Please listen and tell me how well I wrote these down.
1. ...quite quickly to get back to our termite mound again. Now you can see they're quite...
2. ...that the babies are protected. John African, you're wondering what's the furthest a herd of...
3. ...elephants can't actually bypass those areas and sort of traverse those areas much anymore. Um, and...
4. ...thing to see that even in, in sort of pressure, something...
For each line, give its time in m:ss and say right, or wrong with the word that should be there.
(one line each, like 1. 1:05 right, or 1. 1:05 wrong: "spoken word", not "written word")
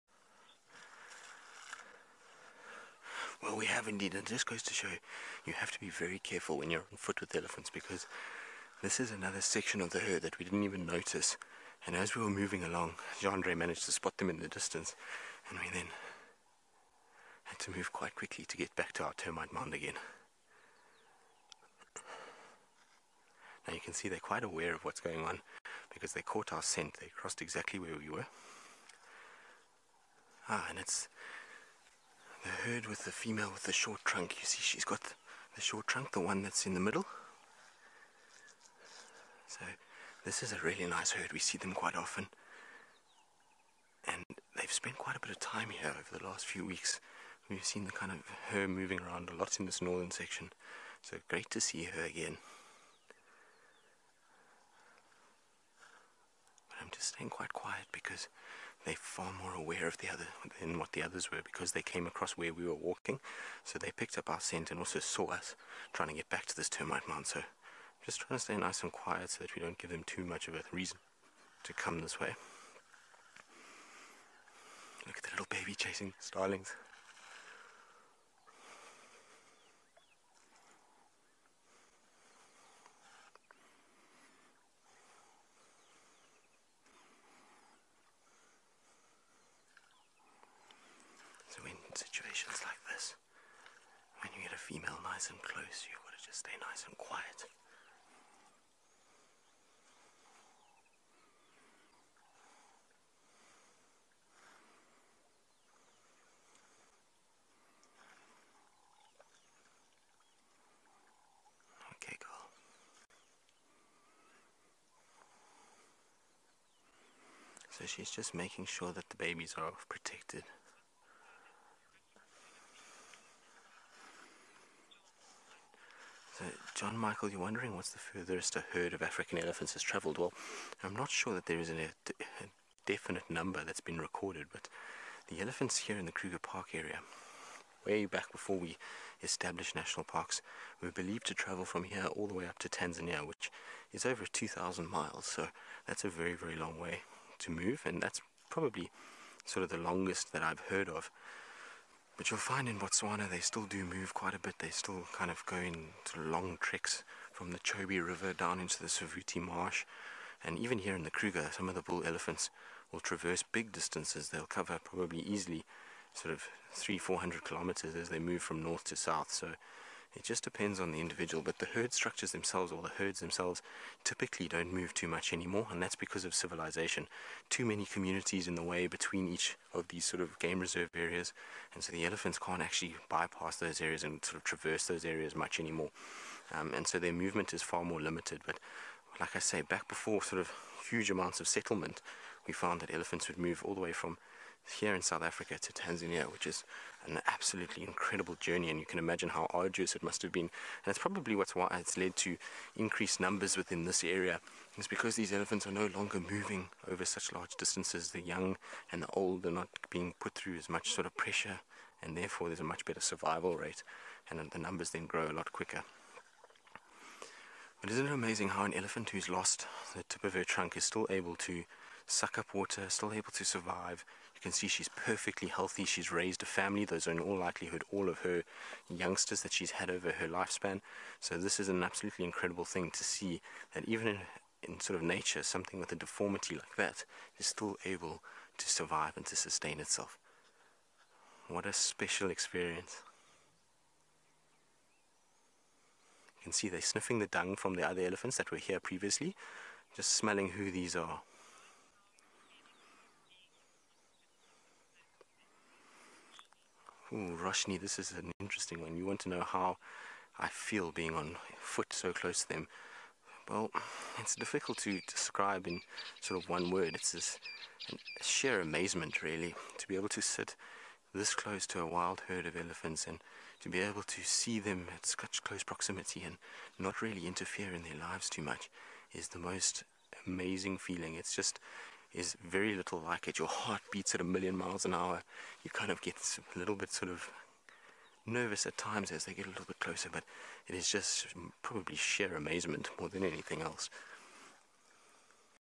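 1. 0:17 right
2. 1:58 wrong: "Michael", not "African"
3. 3:02 right
4. 3:52 wrong: "nature", not "pressure".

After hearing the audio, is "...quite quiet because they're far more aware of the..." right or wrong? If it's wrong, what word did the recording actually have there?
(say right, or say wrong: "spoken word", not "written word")
right.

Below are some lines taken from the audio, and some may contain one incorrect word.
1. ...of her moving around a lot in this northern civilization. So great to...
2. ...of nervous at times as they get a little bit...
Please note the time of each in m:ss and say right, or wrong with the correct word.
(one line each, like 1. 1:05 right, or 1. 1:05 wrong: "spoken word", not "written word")
1. 0:48 wrong: "section", not "civilization"
2. 4:47 right.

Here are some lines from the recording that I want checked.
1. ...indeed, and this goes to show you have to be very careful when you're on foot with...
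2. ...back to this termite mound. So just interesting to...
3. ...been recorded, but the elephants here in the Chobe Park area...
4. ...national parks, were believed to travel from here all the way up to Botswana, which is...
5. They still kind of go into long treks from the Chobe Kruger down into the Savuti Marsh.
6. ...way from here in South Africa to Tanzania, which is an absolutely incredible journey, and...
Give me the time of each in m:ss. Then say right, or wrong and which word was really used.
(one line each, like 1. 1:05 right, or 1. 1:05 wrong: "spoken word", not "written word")
1. 0:03 right
2. 1:06 wrong: "trying", not "interesting"
3. 2:13 wrong: "Kruger", not "Chobe"
4. 2:19 wrong: "Tanzania", not "Botswana"
5. 2:34 wrong: "River", not "Kruger"
6. 3:13 right.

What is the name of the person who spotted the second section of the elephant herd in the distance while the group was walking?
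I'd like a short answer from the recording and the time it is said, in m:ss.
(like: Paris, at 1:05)
Jandre, at 0:13.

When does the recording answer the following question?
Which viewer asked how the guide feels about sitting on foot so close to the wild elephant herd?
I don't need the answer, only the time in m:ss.
4:17.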